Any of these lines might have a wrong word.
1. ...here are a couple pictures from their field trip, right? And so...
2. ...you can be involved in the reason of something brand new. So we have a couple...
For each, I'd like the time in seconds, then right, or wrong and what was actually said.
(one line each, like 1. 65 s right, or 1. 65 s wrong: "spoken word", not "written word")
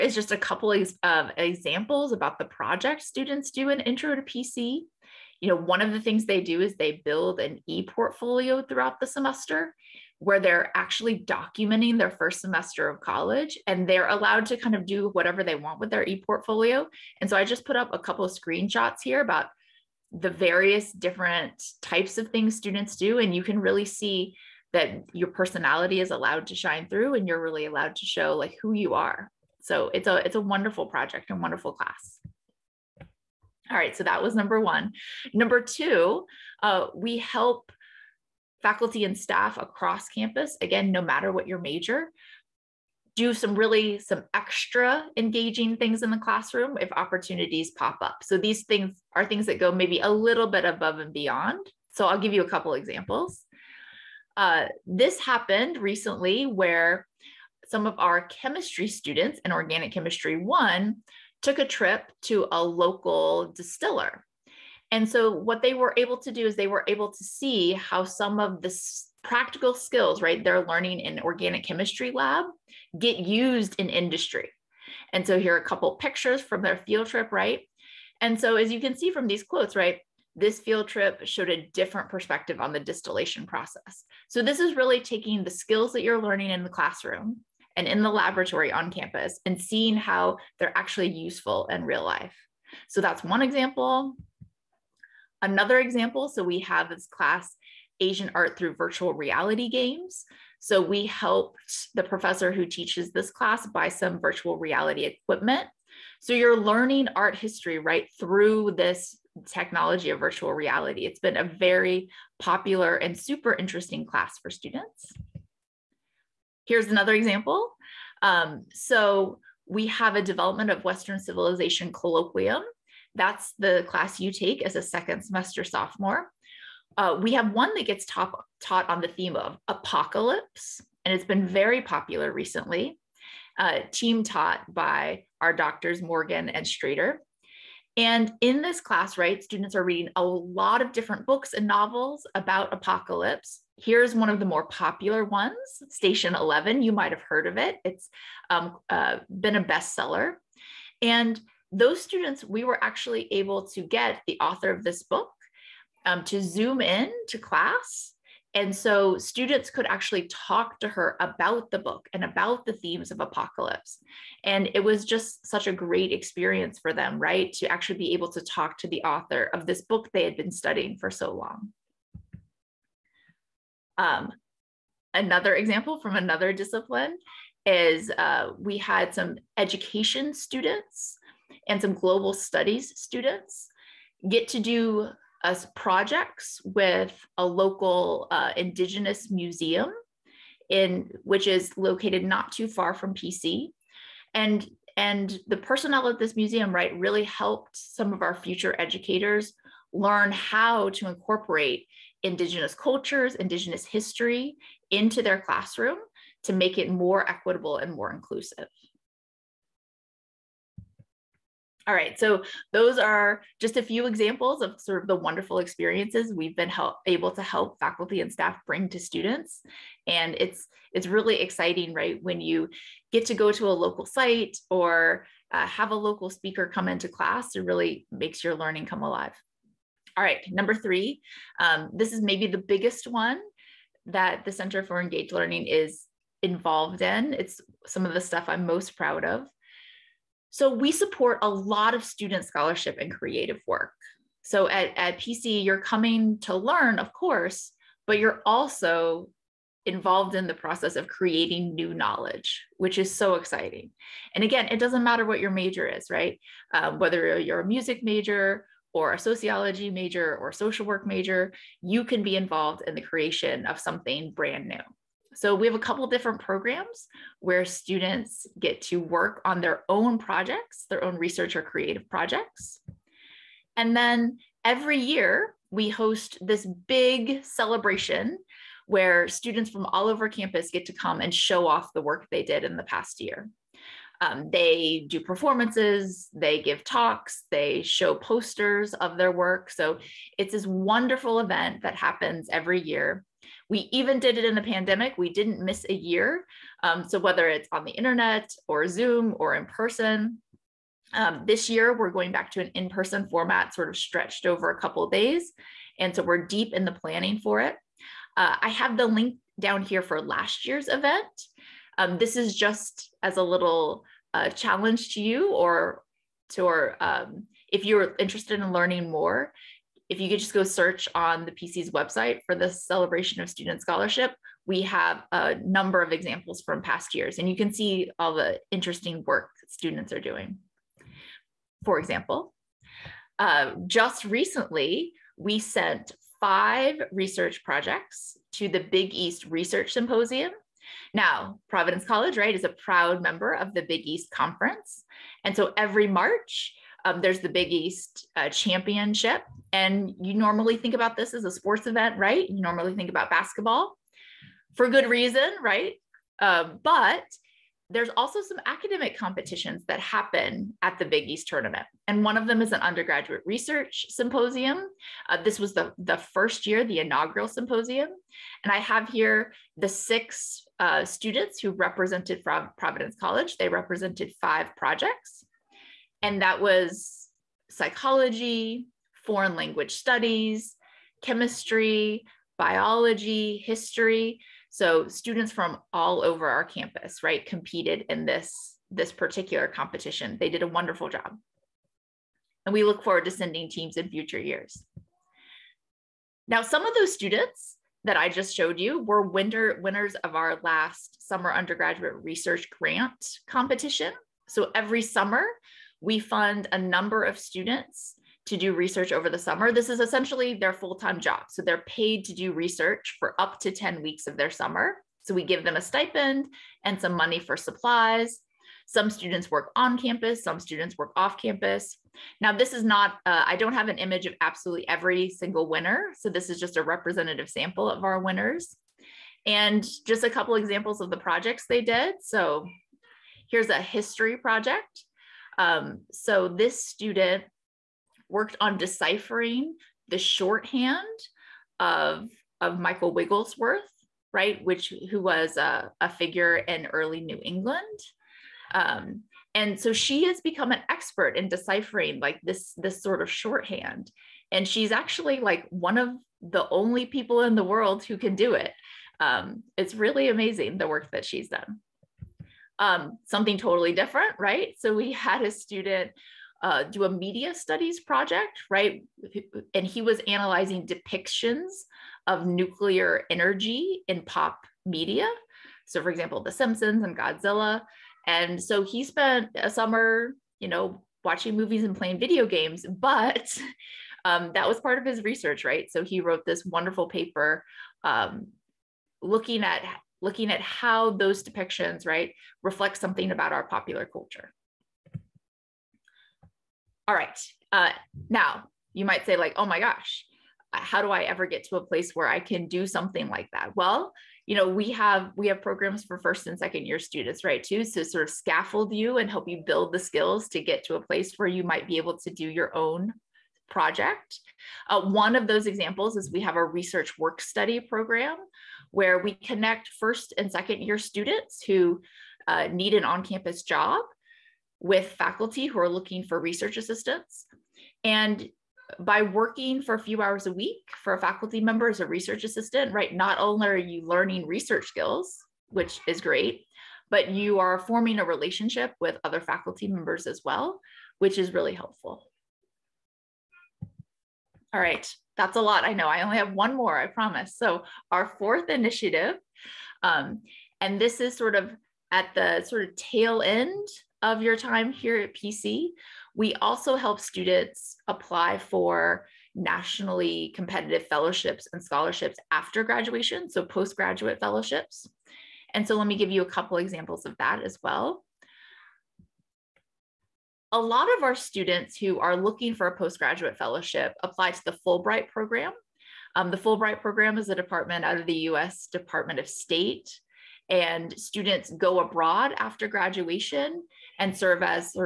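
1. 75 s right
2. 261 s wrong: "creation", not "reason".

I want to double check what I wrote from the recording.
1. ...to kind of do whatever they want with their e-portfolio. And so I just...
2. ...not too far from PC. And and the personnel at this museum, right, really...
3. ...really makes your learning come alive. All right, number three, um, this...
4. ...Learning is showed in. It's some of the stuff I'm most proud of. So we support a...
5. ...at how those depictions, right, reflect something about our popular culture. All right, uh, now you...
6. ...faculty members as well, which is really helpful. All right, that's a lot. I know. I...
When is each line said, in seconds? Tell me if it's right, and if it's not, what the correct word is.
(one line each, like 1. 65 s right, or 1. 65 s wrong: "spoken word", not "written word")
1. 14 s right
2. 192 s right
3. 227 s right
4. 235 s wrong: "involved", not "showed"
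5. 490 s right
6. 539 s right.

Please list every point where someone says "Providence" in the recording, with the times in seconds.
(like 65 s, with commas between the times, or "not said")
341 s, 372 s.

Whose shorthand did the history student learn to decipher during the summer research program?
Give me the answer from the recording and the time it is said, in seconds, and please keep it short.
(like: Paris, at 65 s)
Michael Wigglesworth, at 442 s.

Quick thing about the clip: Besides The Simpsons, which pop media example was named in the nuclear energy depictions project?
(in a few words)
Godzilla.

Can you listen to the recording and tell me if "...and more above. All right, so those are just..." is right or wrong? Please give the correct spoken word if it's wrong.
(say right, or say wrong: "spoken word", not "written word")
wrong: "inclusive", not "above".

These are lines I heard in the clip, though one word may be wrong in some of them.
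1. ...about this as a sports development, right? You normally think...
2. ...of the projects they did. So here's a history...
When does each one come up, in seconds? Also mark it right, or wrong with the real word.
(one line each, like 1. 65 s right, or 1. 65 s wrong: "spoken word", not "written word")
1. 350 s wrong: "event", not "development"
2. 430 s right.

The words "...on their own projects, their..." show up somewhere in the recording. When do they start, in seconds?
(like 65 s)
269 s.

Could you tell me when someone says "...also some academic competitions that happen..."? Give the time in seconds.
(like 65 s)
358 s.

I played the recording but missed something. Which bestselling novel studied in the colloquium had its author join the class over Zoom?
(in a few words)
Station 11.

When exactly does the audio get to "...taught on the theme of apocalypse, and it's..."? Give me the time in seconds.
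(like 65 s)
128 s.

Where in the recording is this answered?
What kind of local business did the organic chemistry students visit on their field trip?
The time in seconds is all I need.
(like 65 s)
63 s.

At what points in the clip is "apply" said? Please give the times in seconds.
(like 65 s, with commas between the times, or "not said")
558 s, 574 s.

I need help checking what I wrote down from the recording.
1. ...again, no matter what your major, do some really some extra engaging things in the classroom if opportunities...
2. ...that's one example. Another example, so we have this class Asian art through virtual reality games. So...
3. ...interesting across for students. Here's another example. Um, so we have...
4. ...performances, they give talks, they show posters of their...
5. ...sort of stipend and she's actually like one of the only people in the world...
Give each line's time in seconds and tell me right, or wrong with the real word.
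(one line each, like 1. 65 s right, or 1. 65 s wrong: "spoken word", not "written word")
1. 40 s right
2. 93 s right
3. 113 s wrong: "class", not "across"
4. 285 s right
5. 453 s wrong: "shorthand", not "stipend".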